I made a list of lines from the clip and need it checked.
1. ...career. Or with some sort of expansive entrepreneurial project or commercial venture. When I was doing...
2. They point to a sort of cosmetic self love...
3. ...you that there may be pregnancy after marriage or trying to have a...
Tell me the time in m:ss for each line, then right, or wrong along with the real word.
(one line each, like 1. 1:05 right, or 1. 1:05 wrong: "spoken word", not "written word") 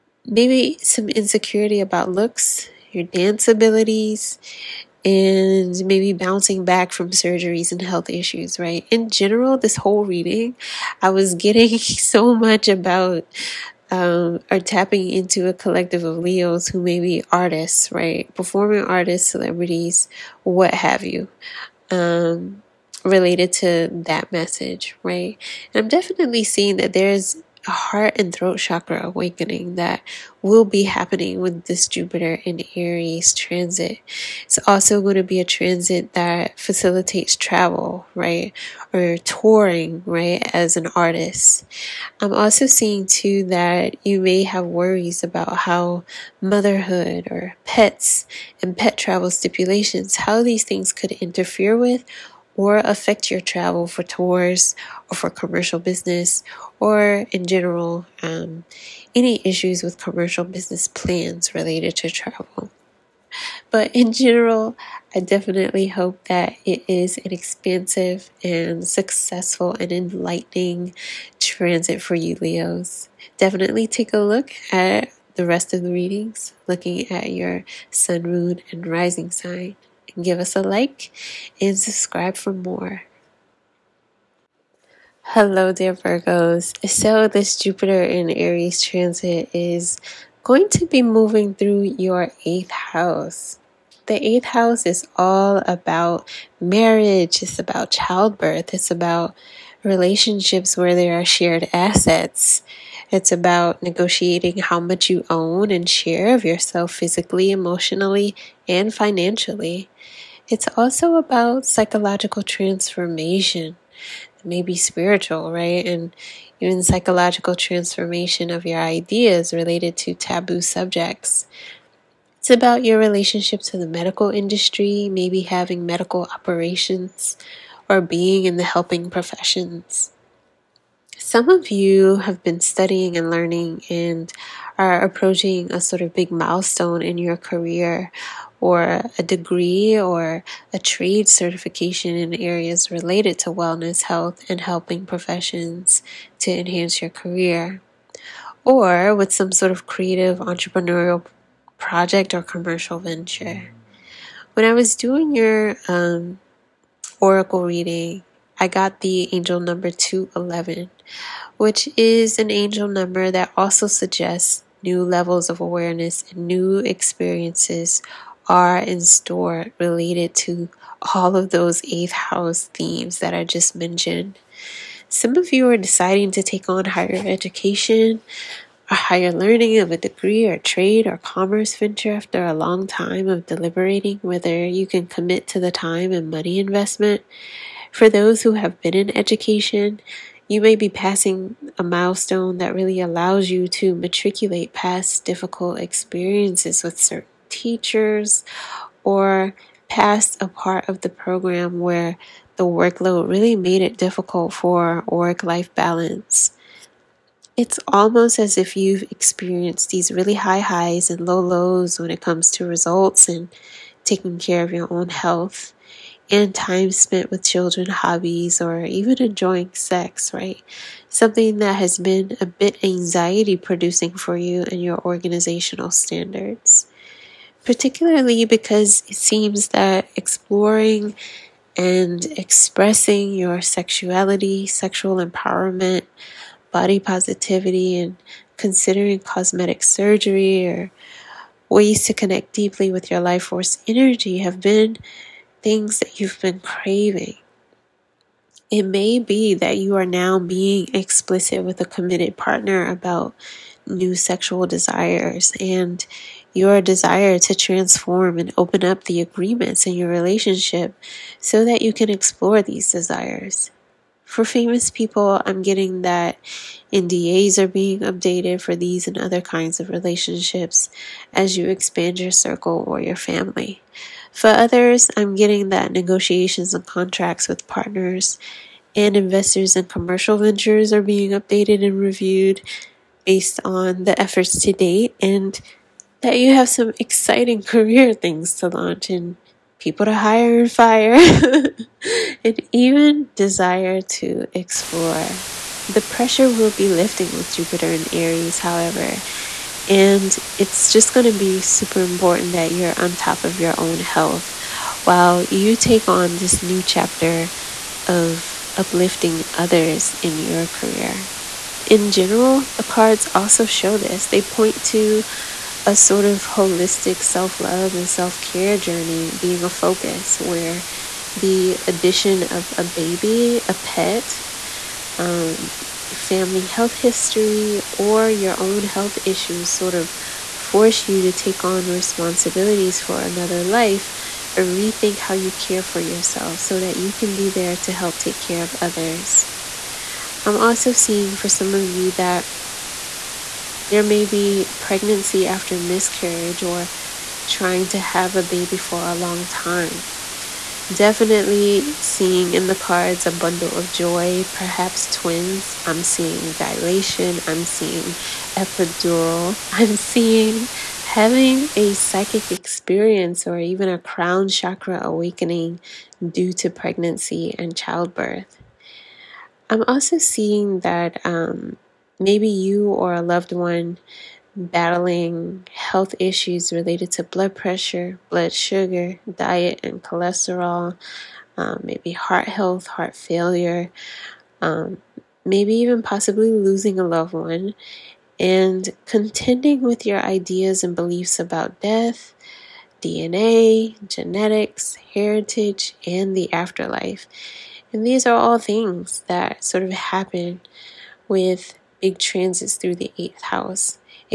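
1. 2:27 wrong: "creative", not "expansive"
2. 5:14 wrong: "holistic", not "cosmetic"
3. 5:41 wrong: "miscarriage", not "marriage".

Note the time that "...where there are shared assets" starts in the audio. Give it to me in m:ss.
1:40.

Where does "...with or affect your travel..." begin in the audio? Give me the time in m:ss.
0:51.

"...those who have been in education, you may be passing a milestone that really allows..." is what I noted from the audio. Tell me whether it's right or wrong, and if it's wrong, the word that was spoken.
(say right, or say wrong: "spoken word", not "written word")
right.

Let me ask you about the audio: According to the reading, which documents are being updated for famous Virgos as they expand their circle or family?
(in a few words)
NDAs.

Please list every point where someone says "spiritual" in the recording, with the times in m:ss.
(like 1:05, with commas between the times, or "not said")
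1:54.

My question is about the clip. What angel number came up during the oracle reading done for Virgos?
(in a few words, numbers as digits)
211.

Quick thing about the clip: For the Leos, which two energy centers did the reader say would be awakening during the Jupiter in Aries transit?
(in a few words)
heart and throat chakra.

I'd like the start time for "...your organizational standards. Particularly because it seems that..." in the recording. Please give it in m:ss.
3:44.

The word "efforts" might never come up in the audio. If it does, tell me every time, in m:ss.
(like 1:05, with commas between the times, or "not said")
4:44.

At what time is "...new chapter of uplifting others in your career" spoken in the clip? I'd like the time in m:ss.
5:06.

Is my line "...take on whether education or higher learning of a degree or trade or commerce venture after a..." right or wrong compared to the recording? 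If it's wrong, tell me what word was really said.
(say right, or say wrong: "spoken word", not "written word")
wrong: "higher", not "whether".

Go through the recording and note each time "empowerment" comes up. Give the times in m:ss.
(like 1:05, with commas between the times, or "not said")
3:55.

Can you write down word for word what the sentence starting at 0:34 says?
It's also going to be a transit that facilitates travel, right?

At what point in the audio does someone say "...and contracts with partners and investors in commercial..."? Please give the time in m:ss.
4:36.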